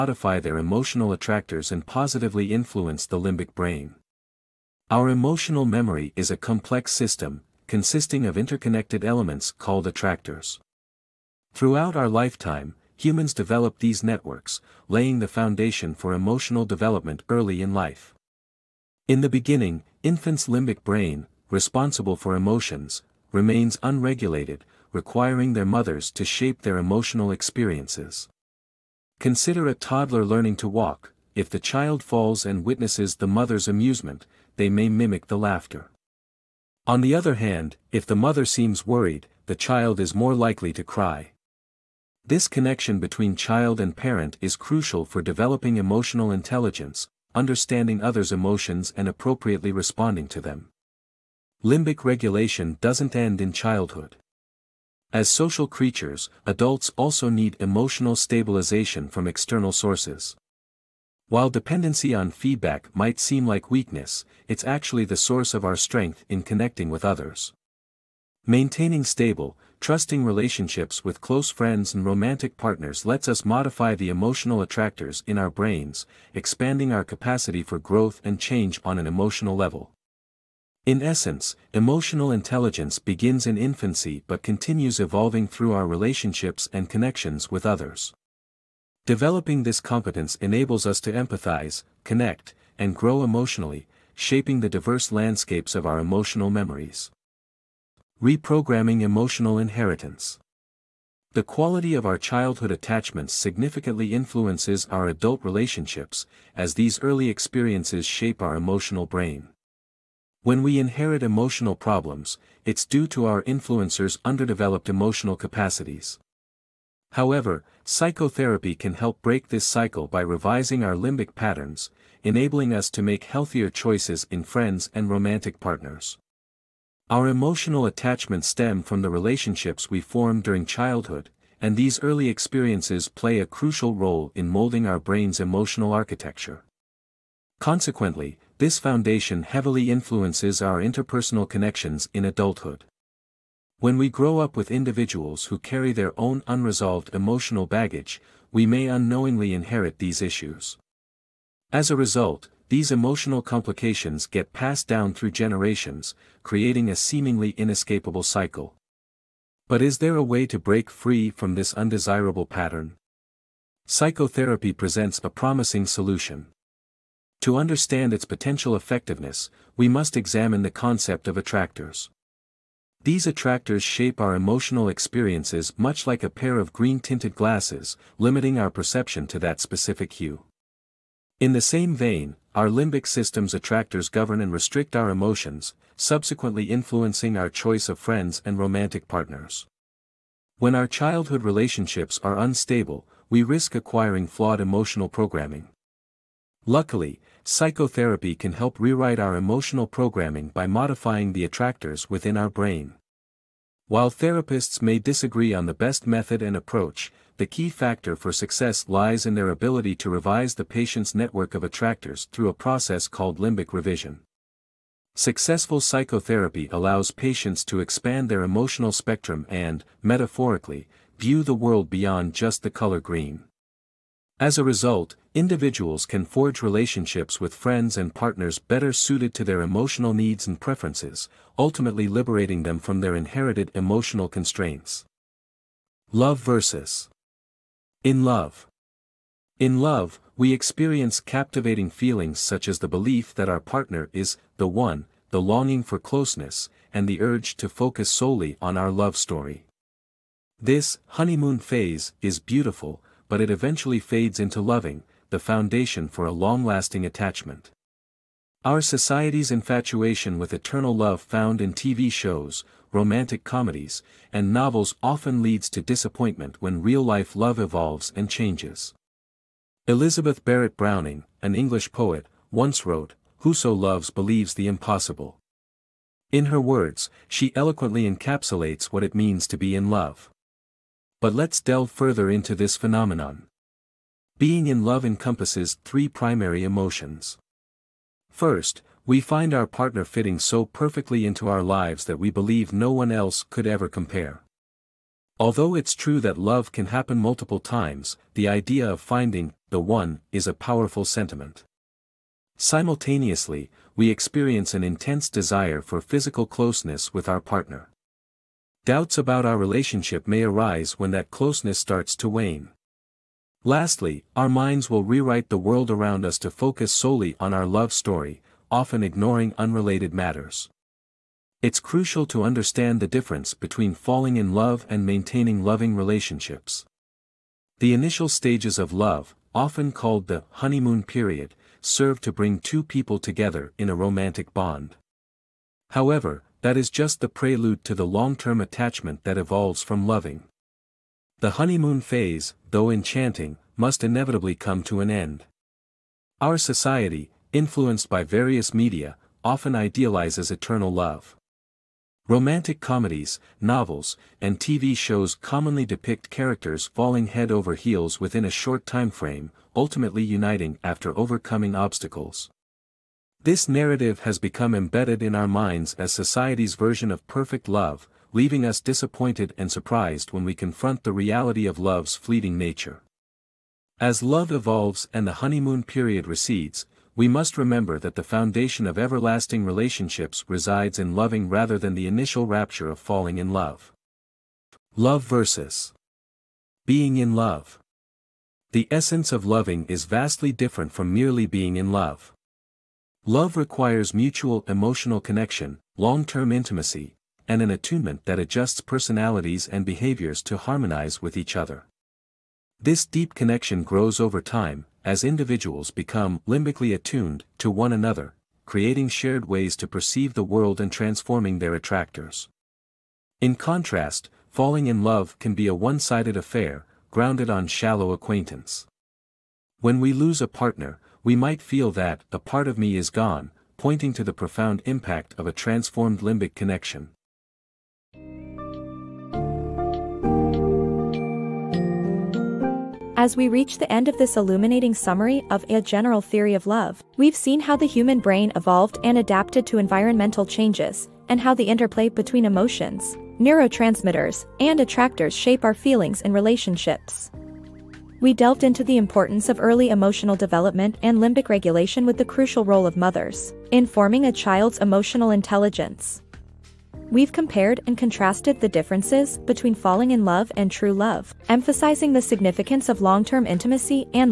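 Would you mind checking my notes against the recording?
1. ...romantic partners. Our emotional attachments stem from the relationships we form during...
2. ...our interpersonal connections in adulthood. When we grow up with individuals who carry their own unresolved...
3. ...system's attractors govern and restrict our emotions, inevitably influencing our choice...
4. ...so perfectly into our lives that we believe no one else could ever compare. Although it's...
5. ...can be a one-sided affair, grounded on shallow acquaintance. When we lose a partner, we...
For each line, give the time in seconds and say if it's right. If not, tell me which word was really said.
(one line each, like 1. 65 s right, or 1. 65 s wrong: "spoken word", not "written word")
1. 125 s right
2. 140 s right
3. 183 s wrong: "subsequently", not "inevitably"
4. 290 s right
5. 415 s right.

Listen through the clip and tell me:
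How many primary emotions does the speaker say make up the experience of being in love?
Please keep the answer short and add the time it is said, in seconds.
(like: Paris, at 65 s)
3, at 285 s.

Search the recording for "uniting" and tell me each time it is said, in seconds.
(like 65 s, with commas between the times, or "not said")
360 s.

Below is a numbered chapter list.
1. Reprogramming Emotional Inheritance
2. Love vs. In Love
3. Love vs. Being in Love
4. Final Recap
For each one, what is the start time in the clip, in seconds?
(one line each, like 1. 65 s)
1. 98 s
2. 236 s
3. 385 s
4. 428 s.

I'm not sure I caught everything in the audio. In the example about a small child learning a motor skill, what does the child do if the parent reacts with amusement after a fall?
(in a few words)
Mimic the laughter.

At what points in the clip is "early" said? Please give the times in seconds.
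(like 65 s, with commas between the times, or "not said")
17 s, 107 s, 132 s, 449 s.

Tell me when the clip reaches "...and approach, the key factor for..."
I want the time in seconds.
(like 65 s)
206 s.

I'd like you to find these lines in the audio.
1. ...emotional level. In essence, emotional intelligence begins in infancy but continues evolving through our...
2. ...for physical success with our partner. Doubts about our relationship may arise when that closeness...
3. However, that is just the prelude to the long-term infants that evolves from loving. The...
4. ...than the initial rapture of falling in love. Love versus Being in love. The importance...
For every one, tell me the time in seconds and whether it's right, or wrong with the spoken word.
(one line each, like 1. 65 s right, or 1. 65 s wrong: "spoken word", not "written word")
1. 79 s right
2. 305 s wrong: "closeness", not "success"
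3. 335 s wrong: "attachment", not "infants"
4. 381 s wrong: "essence", not "importance".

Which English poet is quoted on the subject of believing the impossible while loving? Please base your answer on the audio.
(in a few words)
Elizabeth Barrett Browning.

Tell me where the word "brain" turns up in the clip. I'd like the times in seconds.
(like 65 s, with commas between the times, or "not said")
3 s, 20 s, 75 s, 109 s, 134 s, 202 s, 438 s.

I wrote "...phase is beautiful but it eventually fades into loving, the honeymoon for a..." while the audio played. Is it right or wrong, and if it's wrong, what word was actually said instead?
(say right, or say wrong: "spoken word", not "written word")
wrong: "foundation", not "honeymoon".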